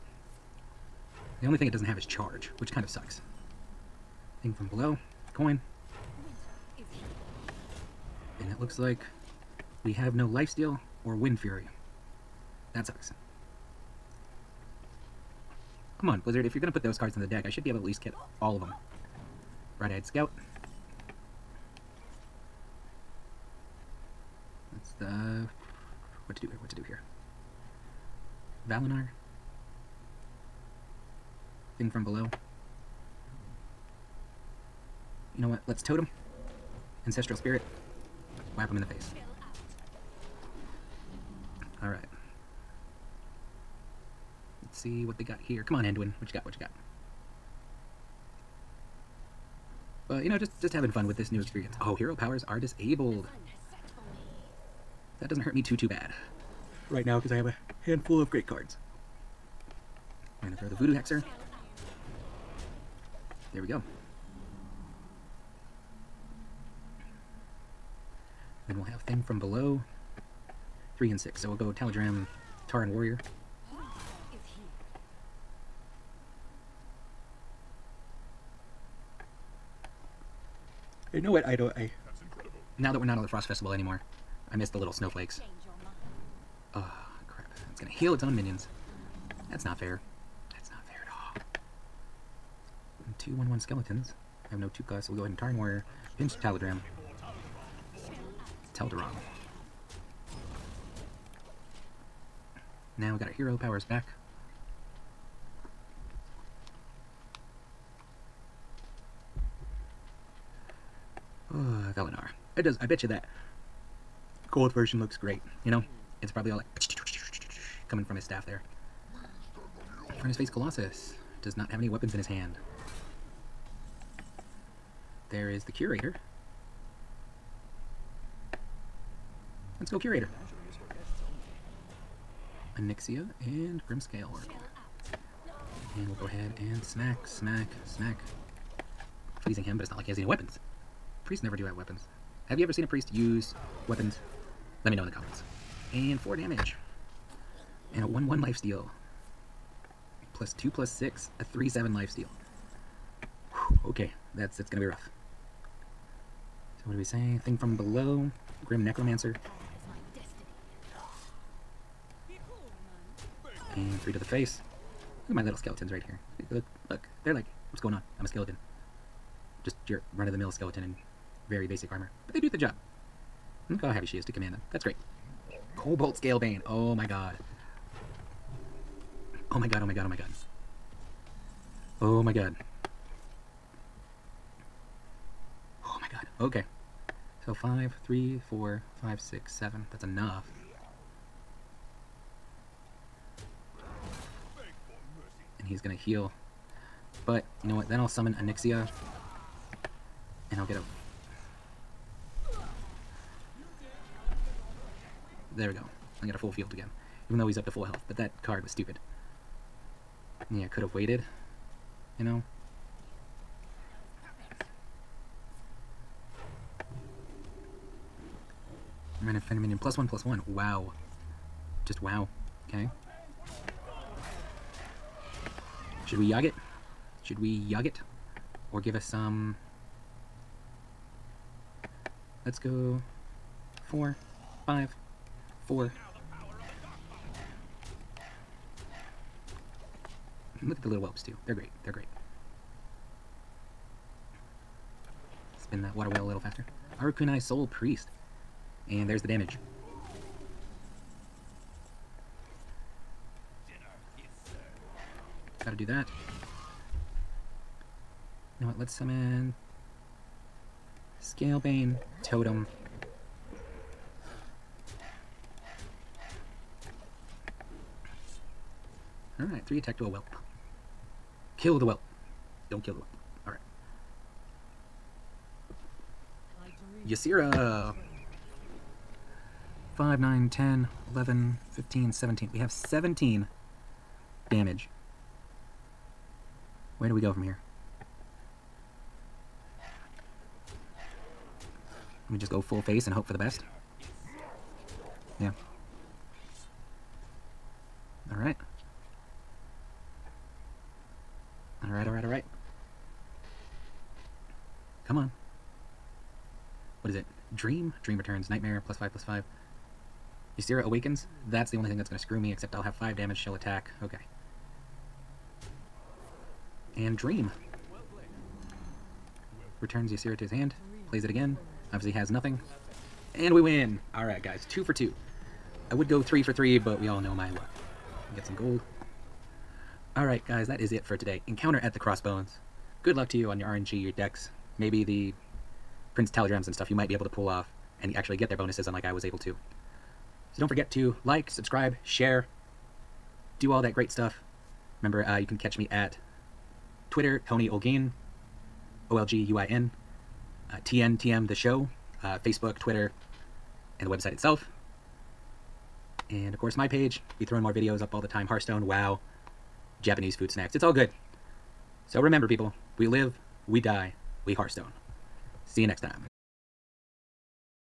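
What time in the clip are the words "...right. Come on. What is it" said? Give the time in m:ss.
5:02.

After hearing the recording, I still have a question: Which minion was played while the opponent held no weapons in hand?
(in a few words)
Furnacefire Colossus.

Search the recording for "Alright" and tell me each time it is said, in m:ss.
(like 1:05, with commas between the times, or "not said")
0:41, 4:29, 5:24, 5:30.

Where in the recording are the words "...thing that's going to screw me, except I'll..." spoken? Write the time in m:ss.
5:11.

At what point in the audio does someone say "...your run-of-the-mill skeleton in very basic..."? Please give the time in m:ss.
2:49.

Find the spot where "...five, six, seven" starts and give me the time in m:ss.
3:09.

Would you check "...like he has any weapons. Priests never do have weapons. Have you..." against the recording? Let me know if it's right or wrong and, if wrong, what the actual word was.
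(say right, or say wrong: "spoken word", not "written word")
right.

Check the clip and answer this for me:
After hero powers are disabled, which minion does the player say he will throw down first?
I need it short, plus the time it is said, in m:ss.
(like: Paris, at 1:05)
Voodoo Hexer, at 1:00.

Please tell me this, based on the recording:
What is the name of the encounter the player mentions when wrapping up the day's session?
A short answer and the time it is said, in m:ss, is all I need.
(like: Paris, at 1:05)
Encounter at the Crossbones, at 5:31.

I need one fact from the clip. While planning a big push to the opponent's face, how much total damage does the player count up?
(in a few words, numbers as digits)
17.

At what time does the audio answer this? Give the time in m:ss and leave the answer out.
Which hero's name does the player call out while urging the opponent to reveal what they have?
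0:45.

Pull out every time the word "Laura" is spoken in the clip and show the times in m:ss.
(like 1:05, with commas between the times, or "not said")
not said.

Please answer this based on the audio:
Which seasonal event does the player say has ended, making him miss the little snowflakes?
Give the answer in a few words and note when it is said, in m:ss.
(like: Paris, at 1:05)
Frost Festival, at 1:23.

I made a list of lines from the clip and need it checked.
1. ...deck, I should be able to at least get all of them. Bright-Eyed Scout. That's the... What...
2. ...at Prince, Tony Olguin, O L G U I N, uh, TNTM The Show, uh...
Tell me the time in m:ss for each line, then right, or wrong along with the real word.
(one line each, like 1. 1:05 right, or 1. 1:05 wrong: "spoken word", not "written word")
1. 0:17 right
2. 5:45 wrong: "Twitter", not "Prince".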